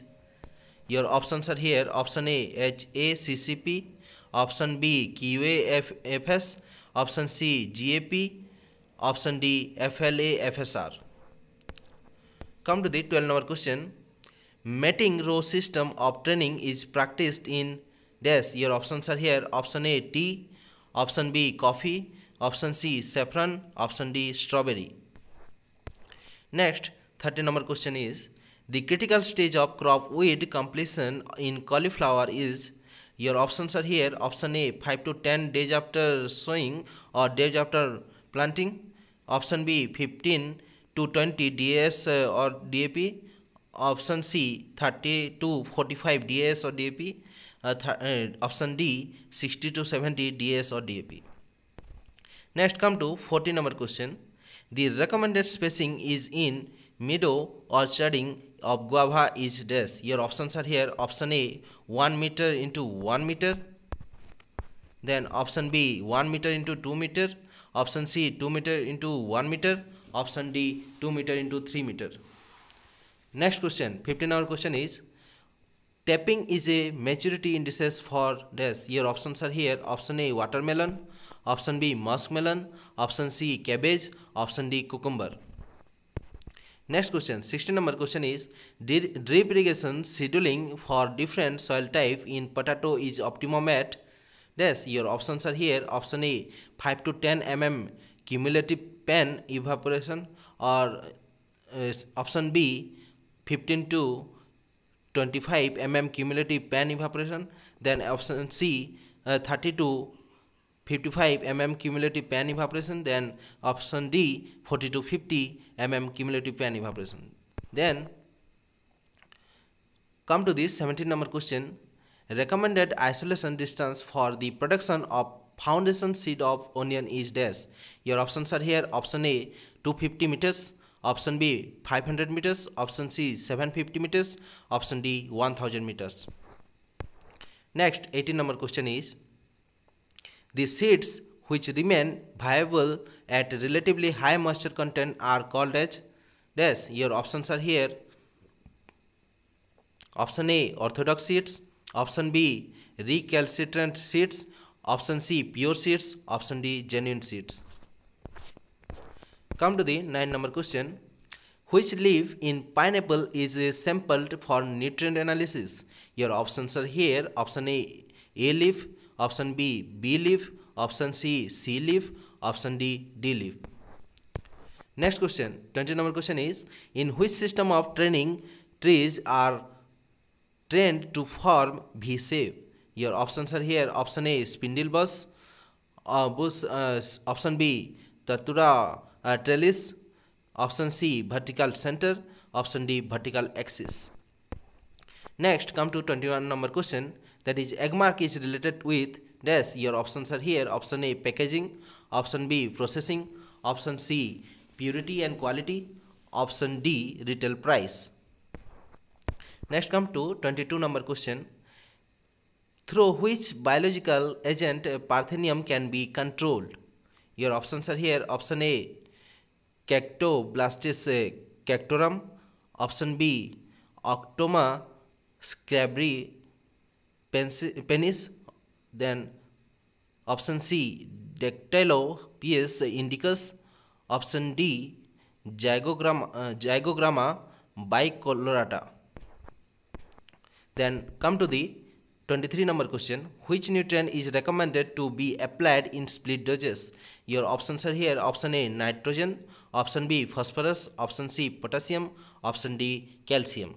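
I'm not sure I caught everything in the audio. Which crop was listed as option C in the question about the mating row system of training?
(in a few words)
Saffron.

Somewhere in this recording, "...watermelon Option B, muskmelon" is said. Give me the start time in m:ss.
1:20.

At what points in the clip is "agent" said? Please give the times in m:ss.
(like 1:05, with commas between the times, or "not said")
3:34.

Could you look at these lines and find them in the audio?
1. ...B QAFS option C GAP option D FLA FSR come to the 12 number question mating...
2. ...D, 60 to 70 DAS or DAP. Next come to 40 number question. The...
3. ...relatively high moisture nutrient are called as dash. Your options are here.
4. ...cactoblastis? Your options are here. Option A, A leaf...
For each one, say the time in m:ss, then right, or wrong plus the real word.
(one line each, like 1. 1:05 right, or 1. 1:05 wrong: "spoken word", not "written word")
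1. 0:04 right
2. 0:48 right
3. 2:23 wrong: "content", not "nutrient"
4. 2:45 wrong: "analysis", not "cactoblastis".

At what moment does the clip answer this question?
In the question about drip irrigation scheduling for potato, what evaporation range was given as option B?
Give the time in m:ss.
1:43.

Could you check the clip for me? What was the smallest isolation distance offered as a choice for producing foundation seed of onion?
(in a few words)
250 meters.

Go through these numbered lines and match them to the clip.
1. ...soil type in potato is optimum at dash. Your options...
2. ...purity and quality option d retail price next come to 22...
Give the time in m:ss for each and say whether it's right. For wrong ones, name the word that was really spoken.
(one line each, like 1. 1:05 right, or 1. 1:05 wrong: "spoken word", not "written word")
1. 1:31 right
2. 3:24 right.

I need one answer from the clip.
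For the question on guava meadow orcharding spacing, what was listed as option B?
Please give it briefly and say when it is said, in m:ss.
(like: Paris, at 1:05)
1 m x 2 m, at 1:06.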